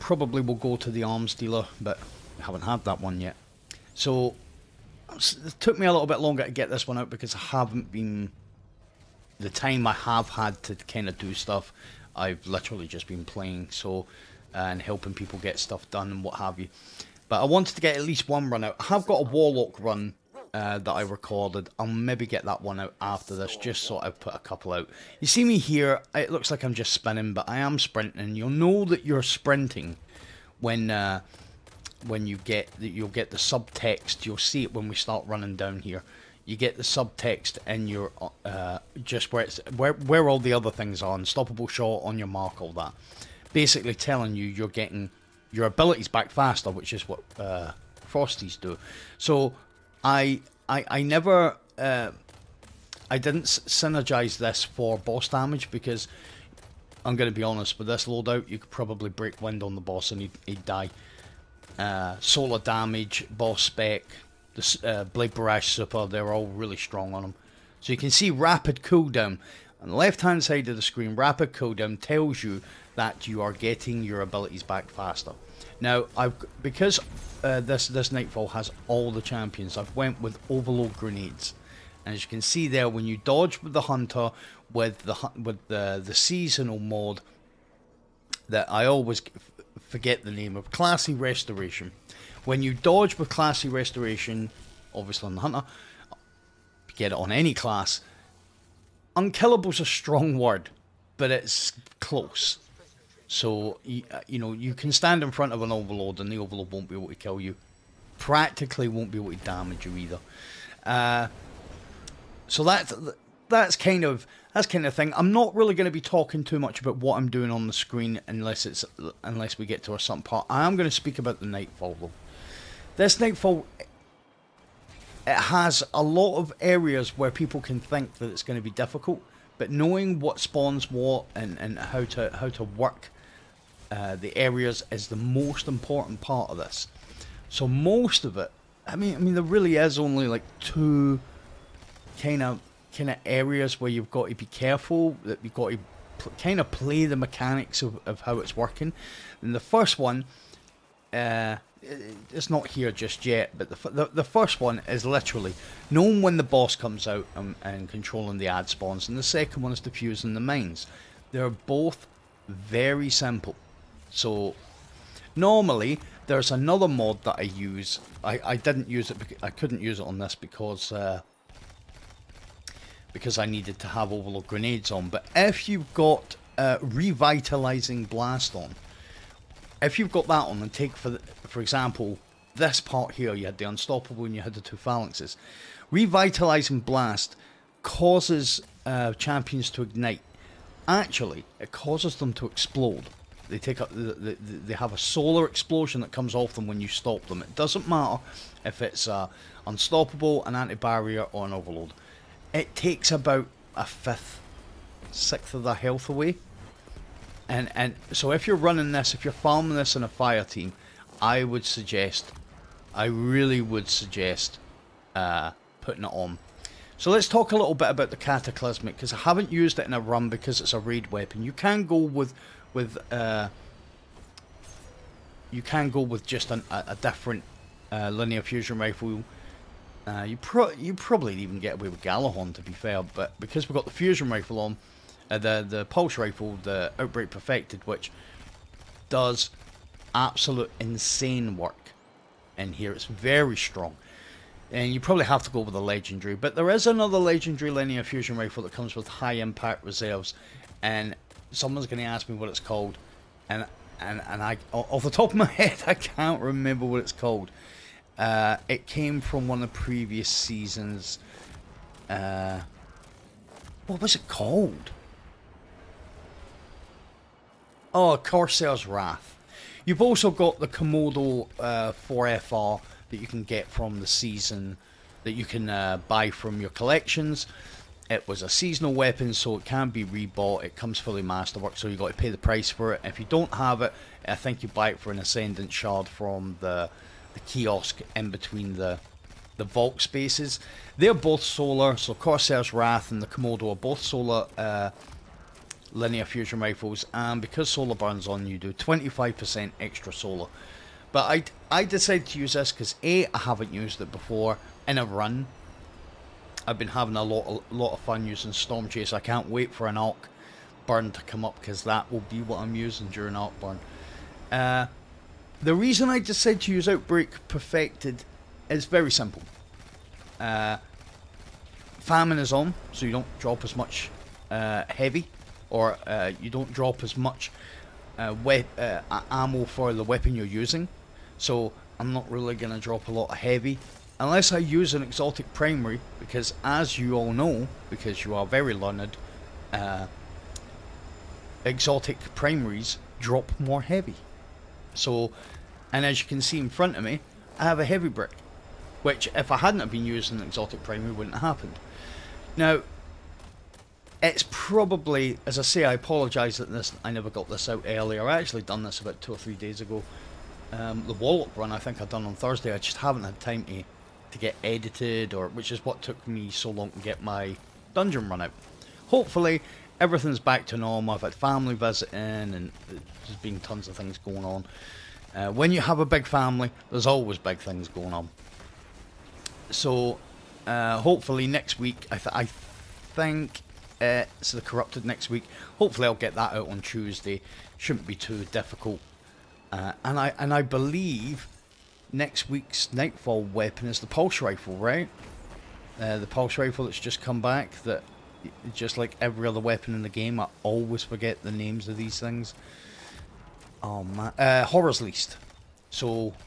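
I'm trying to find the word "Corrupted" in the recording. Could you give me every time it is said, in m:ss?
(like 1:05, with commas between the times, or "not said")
6:24.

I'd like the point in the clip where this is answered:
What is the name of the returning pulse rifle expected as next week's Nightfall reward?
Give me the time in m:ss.
6:44.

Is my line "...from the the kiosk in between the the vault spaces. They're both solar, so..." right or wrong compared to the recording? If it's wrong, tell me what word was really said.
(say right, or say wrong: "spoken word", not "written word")
right.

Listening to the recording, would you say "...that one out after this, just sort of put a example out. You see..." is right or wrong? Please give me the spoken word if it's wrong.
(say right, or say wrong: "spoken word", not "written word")
wrong: "couple", not "example".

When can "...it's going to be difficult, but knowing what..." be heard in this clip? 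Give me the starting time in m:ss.
2:08.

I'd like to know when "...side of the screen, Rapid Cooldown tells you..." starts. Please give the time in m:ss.
1:10.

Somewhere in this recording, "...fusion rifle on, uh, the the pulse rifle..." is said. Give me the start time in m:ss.
3:53.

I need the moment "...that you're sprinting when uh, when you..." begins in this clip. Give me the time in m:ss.
0:28.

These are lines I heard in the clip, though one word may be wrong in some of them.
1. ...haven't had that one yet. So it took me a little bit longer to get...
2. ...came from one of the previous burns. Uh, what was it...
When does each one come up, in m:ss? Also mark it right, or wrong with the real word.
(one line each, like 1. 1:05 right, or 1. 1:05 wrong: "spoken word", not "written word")
1. 0:02 right
2. 4:18 wrong: "seasons", not "burns".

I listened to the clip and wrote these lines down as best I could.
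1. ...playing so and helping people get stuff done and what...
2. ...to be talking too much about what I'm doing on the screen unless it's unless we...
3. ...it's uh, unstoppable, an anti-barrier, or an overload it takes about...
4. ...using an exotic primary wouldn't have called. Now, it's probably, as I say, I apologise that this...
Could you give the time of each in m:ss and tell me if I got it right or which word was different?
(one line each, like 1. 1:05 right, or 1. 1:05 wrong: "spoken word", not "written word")
1. 0:13 right
2. 1:55 right
3. 3:18 right
4. 5:50 wrong: "happened", not "called".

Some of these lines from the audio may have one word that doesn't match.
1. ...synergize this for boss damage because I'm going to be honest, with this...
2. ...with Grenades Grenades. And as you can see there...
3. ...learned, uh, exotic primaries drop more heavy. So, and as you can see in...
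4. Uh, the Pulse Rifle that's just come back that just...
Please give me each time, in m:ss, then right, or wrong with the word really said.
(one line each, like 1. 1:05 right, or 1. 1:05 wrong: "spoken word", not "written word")
1. 0:53 right
2. 1:20 wrong: "Overload", not "Grenades"
3. 5:38 right
4. 6:36 right.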